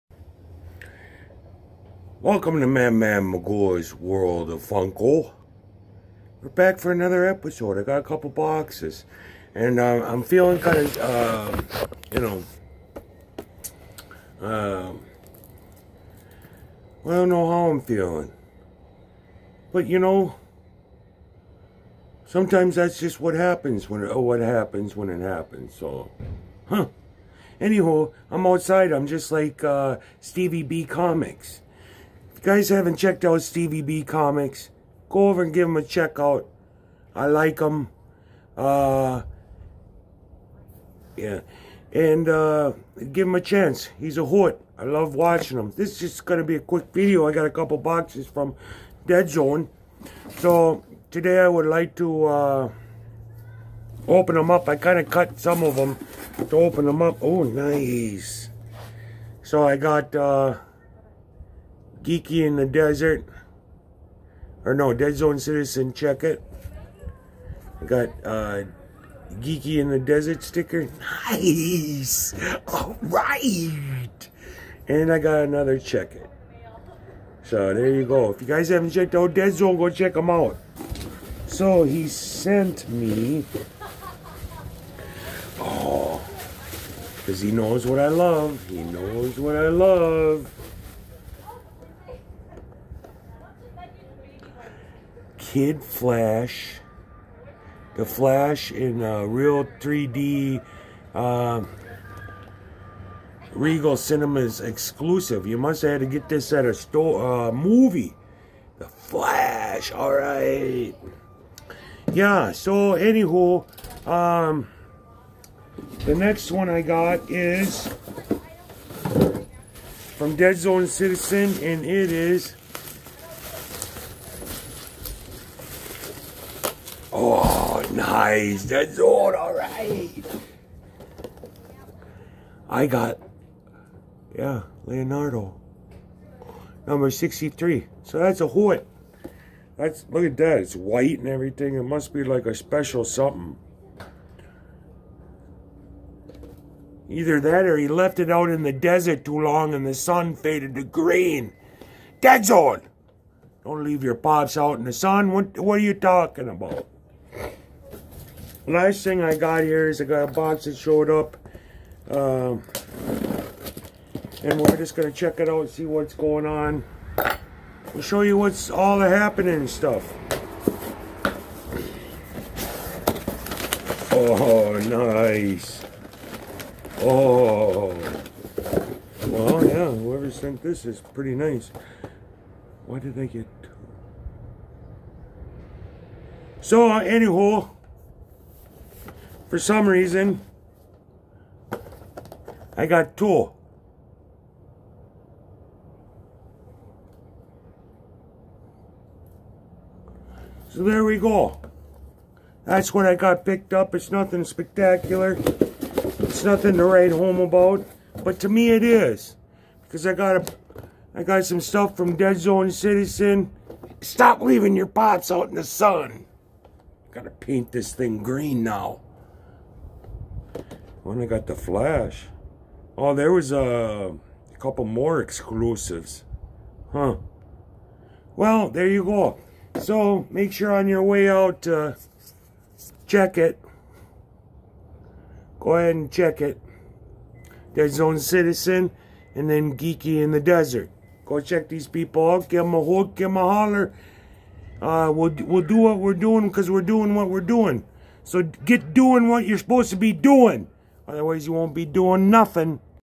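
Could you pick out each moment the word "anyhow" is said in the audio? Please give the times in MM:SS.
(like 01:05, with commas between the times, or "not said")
00:27, 03:07.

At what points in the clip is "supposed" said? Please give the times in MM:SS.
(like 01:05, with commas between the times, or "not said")
04:09.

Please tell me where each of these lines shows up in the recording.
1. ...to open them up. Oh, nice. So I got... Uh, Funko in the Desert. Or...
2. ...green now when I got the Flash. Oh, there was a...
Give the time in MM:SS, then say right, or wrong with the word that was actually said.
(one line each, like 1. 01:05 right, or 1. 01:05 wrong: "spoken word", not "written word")
1. 00:56 wrong: "Geeky", not "Funko"
2. 03:38 right.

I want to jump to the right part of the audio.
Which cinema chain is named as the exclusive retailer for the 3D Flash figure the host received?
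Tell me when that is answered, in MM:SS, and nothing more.
01:43.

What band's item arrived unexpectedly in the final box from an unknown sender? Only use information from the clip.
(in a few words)
Tool.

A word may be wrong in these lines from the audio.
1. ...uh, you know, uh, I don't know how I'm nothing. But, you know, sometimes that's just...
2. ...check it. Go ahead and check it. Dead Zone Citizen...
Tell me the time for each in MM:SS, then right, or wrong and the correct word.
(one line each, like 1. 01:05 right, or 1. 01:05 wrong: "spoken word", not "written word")
1. 00:10 wrong: "feeling", not "nothing"
2. 03:53 right.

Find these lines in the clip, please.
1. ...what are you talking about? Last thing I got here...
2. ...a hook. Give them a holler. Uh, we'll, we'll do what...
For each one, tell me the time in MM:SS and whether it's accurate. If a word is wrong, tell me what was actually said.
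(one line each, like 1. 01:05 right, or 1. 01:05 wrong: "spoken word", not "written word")
1. 02:35 right
2. 04:02 right.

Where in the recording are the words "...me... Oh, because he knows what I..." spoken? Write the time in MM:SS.
01:22.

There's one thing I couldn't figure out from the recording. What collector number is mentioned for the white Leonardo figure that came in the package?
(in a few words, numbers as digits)
63.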